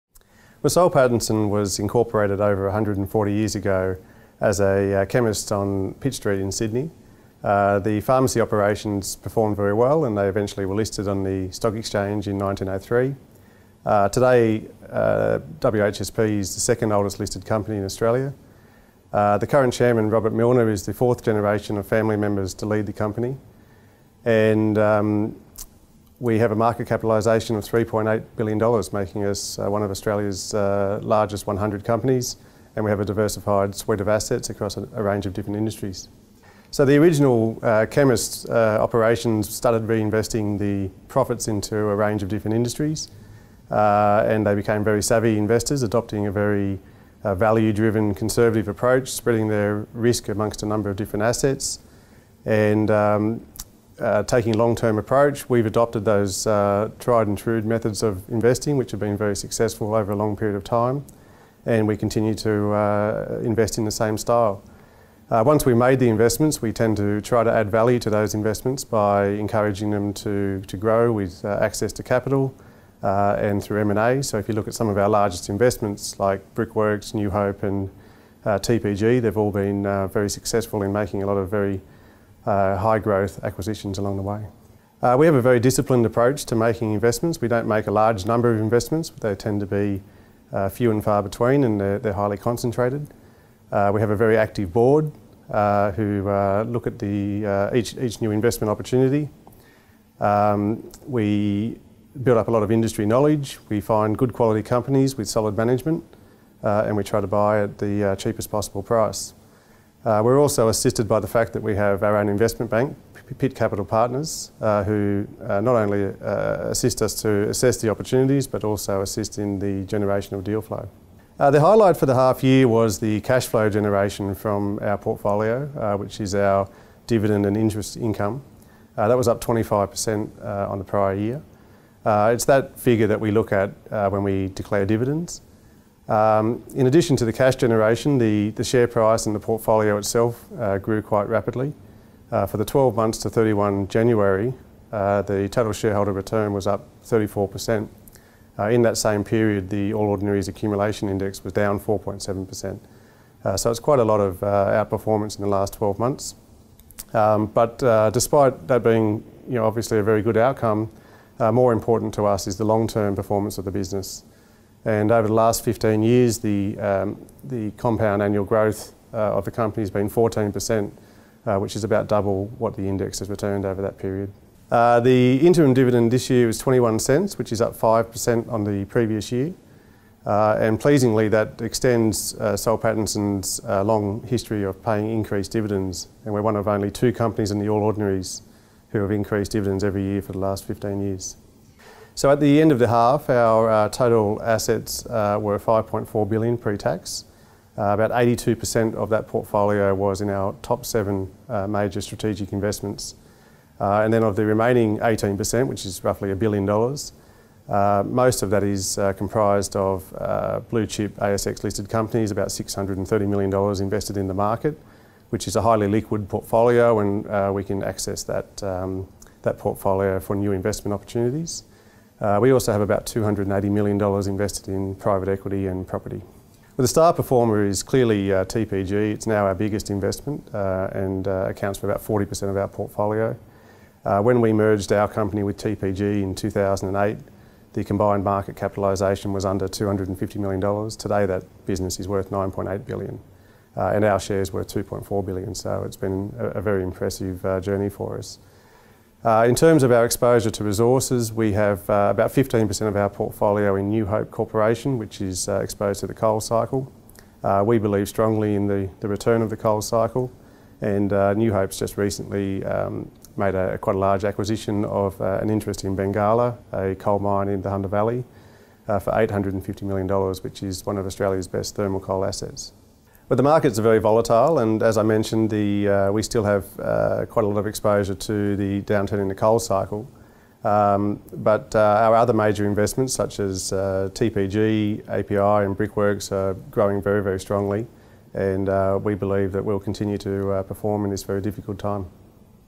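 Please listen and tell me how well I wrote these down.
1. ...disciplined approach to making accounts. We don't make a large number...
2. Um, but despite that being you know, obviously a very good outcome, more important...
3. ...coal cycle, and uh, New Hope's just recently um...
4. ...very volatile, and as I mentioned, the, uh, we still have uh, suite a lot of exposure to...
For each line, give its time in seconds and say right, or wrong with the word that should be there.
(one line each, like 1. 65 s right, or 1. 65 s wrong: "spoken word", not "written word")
1. 85 s wrong: "investments", not "accounts"
2. 157 s right
3. 259 s right
4. 273 s wrong: "quite", not "suite".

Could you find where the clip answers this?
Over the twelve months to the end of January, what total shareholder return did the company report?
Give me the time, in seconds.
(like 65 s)
147 s.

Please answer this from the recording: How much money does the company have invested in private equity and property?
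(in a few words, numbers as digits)
$280 million.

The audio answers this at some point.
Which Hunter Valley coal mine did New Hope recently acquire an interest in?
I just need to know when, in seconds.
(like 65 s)
265 s.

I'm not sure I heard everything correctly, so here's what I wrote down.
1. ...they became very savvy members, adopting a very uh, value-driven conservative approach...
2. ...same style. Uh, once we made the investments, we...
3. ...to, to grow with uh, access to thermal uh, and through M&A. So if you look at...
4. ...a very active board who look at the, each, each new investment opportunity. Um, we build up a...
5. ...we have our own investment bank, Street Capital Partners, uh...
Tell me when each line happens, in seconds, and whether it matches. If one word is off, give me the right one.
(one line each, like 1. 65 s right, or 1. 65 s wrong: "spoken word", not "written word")
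1. 44 s wrong: "investors", not "members"
2. 63 s right
3. 70 s wrong: "capital", not "thermal"
4. 94 s right
5. 111 s wrong: "Pitt", not "Street".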